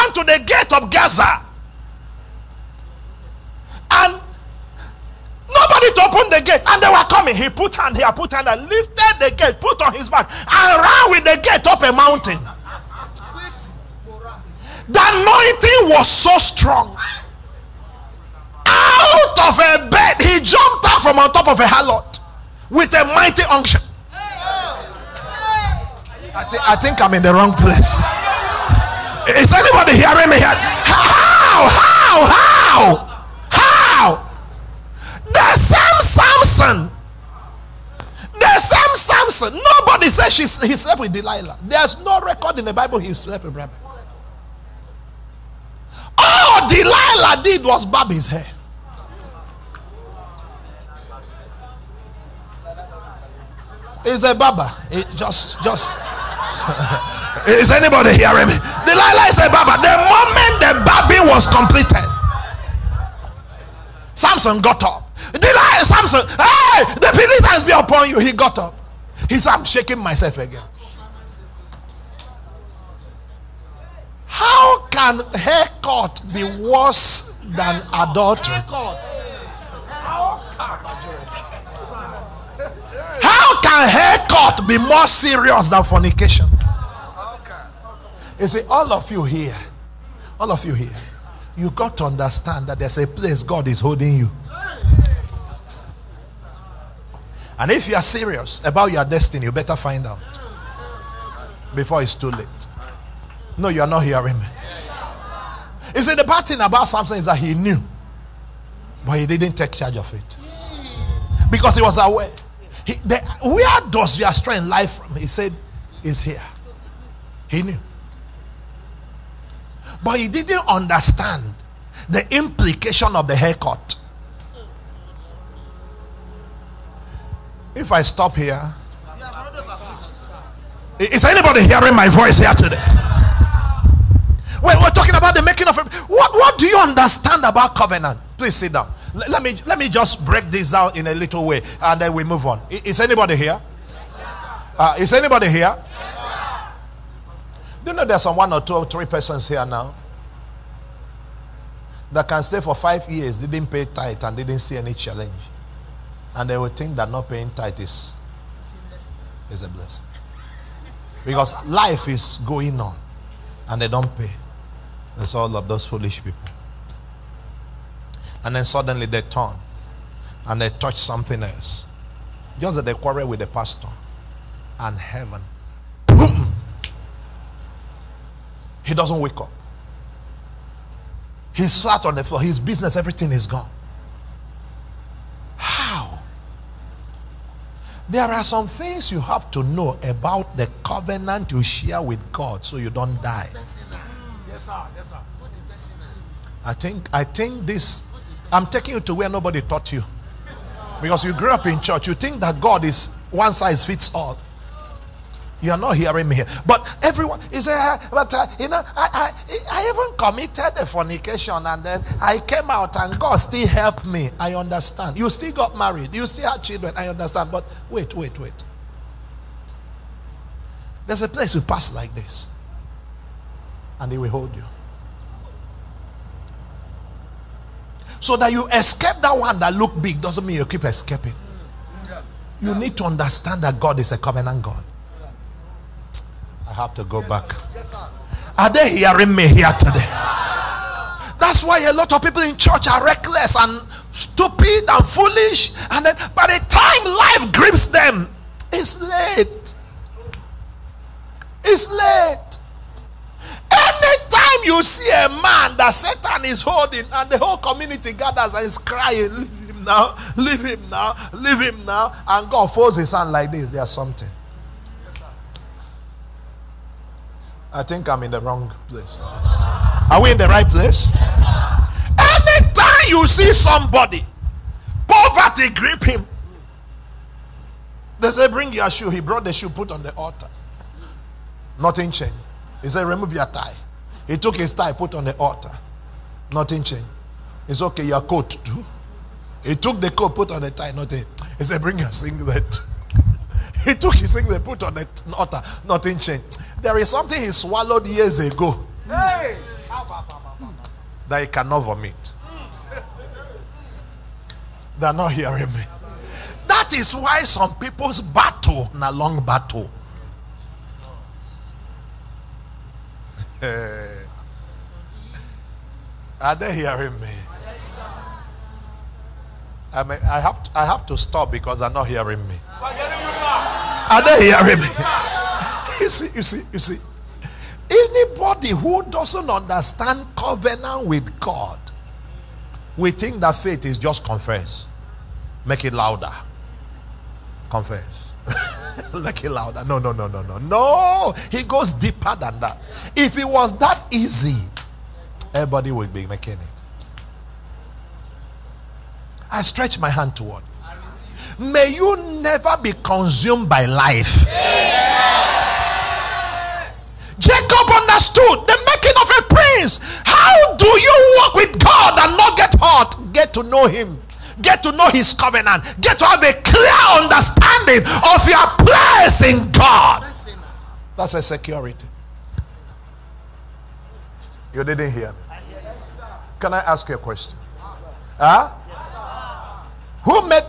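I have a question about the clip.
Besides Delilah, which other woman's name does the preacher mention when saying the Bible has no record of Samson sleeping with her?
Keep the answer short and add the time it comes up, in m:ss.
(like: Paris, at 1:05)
Rebecca, at 0:43.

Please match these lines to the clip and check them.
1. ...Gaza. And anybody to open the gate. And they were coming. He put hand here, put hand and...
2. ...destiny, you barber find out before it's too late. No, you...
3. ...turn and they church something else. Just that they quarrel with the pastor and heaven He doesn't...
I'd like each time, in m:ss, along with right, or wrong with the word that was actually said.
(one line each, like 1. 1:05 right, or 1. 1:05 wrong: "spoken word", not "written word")
1. 0:00 wrong: "nobody", not "anybody"
2. 1:39 wrong: "better", not "barber"
3. 2:49 wrong: "touch", not "church".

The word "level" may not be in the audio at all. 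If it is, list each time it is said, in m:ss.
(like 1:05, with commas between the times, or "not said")
not said.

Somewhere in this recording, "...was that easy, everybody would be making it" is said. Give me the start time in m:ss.
5:43.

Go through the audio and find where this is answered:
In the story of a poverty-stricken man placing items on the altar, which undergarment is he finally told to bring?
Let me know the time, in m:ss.
4:52.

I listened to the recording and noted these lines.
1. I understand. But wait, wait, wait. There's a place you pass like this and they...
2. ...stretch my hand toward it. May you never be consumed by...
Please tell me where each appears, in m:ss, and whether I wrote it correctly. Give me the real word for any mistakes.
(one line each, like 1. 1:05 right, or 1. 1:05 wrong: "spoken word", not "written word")
1. 3:36 right
2. 5:49 right.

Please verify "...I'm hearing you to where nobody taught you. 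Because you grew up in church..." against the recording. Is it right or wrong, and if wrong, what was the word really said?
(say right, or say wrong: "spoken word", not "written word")
wrong: "taking", not "hearing".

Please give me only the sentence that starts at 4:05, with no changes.
And then by the time life grips them, it's late.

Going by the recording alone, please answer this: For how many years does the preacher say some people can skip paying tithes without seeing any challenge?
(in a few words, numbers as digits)
5.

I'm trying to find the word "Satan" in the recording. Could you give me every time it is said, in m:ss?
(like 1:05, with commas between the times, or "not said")
4:15.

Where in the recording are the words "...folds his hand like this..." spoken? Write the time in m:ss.
4:22.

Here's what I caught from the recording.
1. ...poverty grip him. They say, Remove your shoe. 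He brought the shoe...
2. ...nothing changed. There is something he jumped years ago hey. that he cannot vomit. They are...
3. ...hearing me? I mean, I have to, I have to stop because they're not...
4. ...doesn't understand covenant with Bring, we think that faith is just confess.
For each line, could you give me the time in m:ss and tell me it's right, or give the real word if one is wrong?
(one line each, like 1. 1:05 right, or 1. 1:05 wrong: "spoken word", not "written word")
1. 4:35 wrong: "Bring", not "Remove"
2. 4:55 wrong: "swallowed", not "jumped"
3. 5:16 right
4. 5:29 wrong: "God", not "Bring".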